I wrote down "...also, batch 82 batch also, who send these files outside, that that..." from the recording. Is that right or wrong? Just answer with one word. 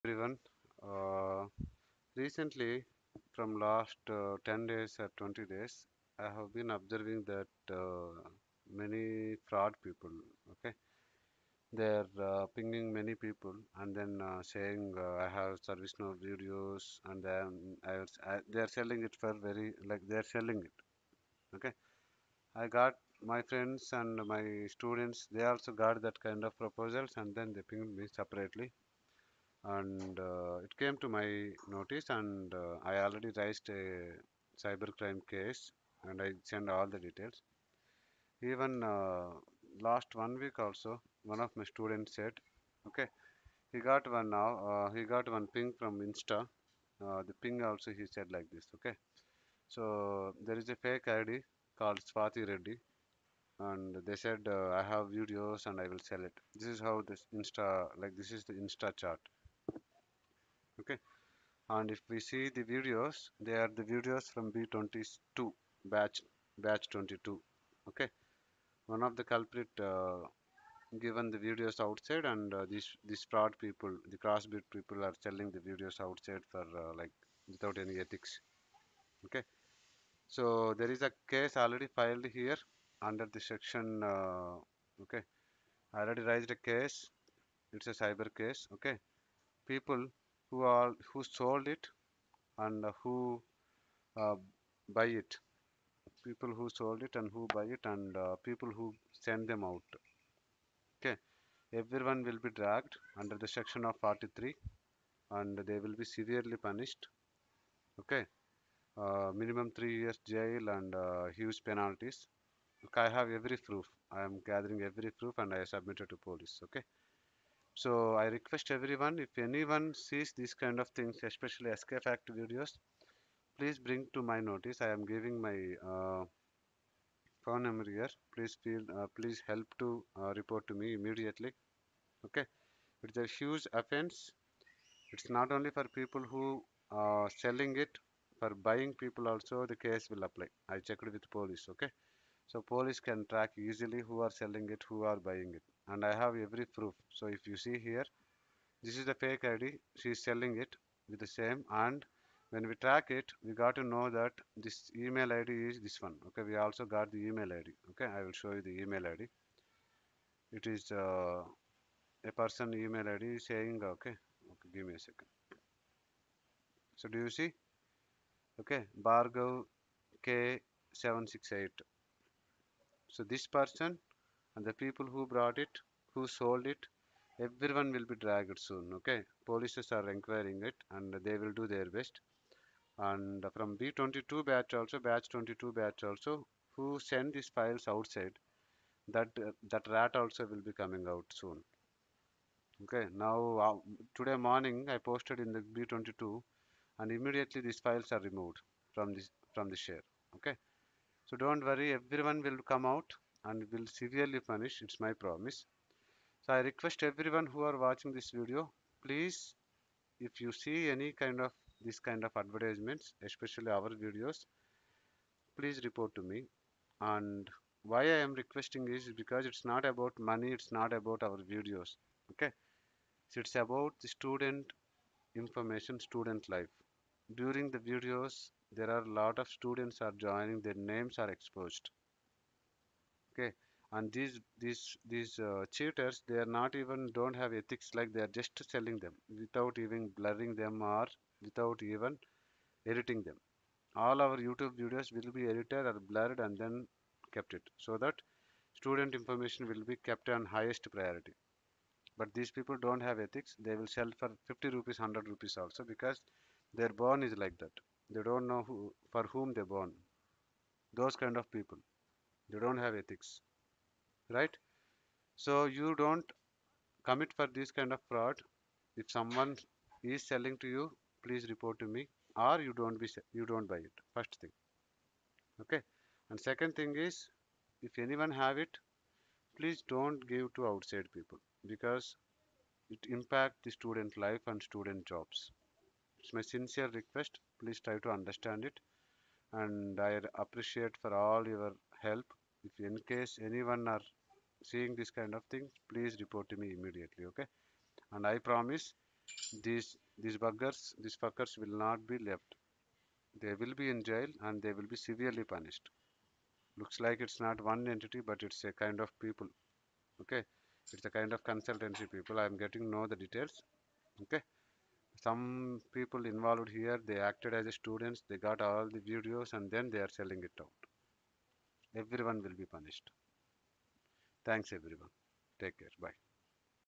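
wrong.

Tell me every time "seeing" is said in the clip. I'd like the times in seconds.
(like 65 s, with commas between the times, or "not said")
294 s.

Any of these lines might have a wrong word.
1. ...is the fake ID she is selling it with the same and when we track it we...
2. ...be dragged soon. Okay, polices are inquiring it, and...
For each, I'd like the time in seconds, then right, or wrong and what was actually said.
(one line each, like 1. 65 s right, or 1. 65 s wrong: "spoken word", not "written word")
1. 149 s right
2. 178 s right.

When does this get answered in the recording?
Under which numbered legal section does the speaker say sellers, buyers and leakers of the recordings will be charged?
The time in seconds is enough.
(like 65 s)
104 s.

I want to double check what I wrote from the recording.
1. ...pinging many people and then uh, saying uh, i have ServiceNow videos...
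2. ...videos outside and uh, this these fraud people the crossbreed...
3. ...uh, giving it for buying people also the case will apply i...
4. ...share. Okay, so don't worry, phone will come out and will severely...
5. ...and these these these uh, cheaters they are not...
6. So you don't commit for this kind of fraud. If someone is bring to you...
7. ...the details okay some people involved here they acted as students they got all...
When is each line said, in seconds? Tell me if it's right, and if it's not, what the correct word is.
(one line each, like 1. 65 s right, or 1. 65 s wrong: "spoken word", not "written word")
1. 12 s right
2. 71 s right
3. 137 s wrong: "selling", not "giving"
4. 199 s wrong: "everyone", not "phone"
5. 233 s right
6. 265 s wrong: "selling", not "bring"
7. 313 s right.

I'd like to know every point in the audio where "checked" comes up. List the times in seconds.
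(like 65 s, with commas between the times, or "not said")
140 s.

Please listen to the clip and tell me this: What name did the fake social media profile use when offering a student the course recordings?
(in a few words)
Swati Reddy.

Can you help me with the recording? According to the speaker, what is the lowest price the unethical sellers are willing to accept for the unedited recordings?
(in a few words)
50 rupees.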